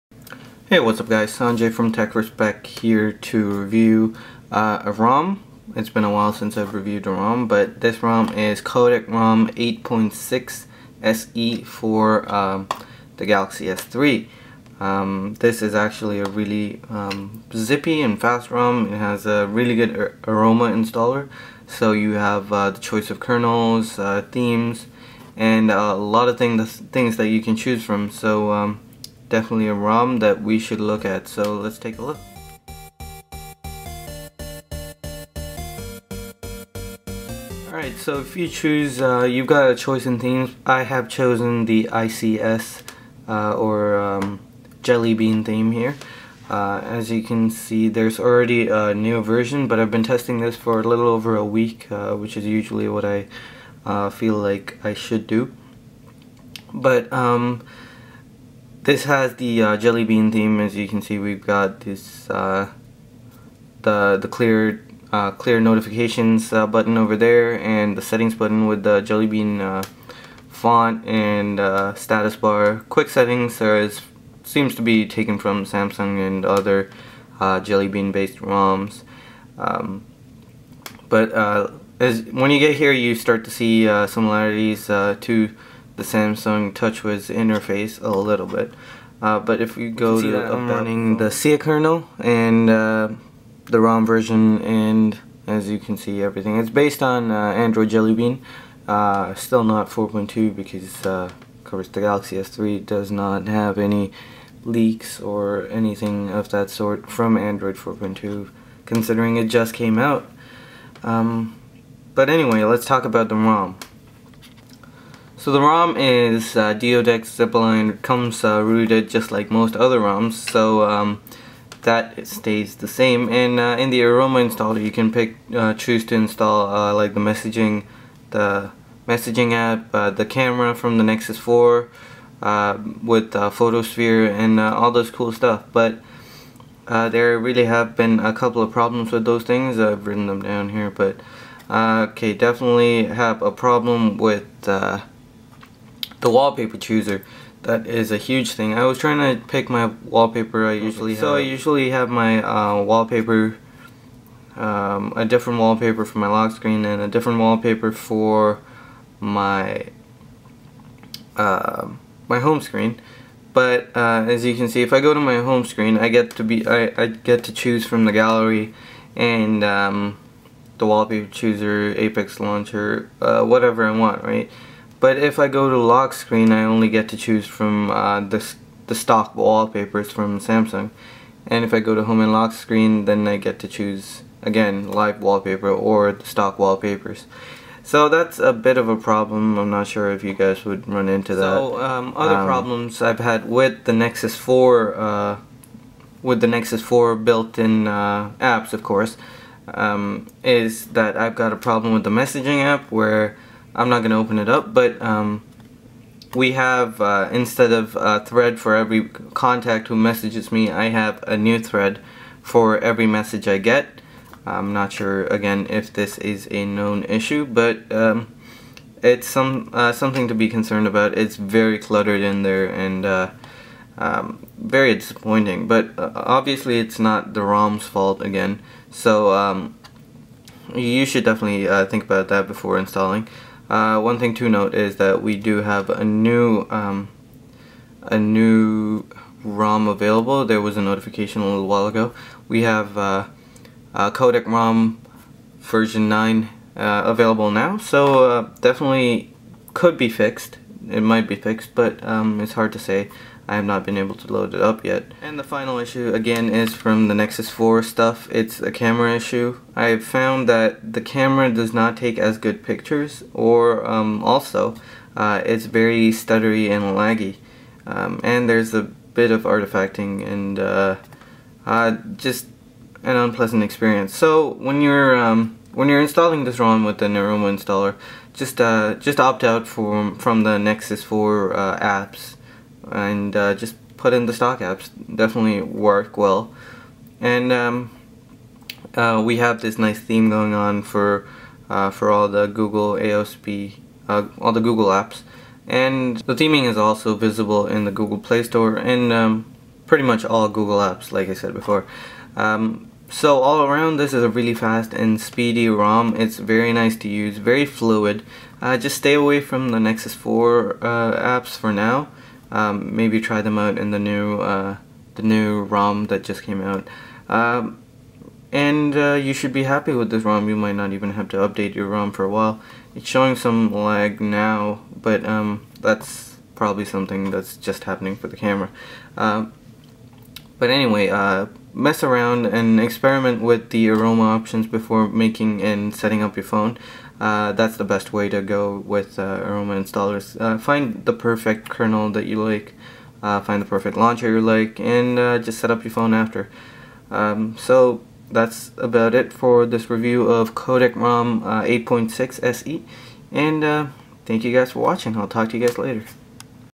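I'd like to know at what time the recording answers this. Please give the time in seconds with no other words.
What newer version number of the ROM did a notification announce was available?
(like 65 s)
245 s.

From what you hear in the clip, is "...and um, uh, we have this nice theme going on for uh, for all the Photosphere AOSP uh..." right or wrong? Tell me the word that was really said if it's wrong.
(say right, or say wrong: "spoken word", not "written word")
wrong: "Google", not "Photosphere".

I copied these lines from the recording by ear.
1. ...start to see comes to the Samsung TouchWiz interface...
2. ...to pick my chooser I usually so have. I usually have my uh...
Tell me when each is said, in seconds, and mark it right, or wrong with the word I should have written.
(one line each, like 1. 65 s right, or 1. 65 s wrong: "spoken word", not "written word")
1. 83 s wrong: "similarities", not "comes"
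2. 149 s wrong: "wallpaper", not "chooser".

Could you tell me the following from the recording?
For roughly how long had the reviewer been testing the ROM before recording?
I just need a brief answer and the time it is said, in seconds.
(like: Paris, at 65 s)
A little over a week, at 50 s.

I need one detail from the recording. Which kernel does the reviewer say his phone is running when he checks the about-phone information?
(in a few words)
Siyah.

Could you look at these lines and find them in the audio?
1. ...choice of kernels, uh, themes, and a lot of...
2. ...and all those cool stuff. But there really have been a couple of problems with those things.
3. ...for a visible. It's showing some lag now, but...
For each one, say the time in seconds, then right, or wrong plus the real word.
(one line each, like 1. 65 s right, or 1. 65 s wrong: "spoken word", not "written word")
1. 22 s right
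2. 134 s right
3. 322 s wrong: "while", not "visible".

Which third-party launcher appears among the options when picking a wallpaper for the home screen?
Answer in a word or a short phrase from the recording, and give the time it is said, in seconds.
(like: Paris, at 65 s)
Apex Launcher, at 171 s.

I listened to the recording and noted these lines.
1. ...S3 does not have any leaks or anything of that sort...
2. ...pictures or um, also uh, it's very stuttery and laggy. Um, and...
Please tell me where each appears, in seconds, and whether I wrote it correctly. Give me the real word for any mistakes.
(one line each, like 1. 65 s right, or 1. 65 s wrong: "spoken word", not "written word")
1. 102 s right
2. 262 s right.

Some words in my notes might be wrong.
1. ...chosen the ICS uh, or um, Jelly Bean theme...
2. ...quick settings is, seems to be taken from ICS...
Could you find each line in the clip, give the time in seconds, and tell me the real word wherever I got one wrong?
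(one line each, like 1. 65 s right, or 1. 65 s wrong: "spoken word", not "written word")
1. 41 s right
2. 72 s wrong: "Samsung", not "ICS".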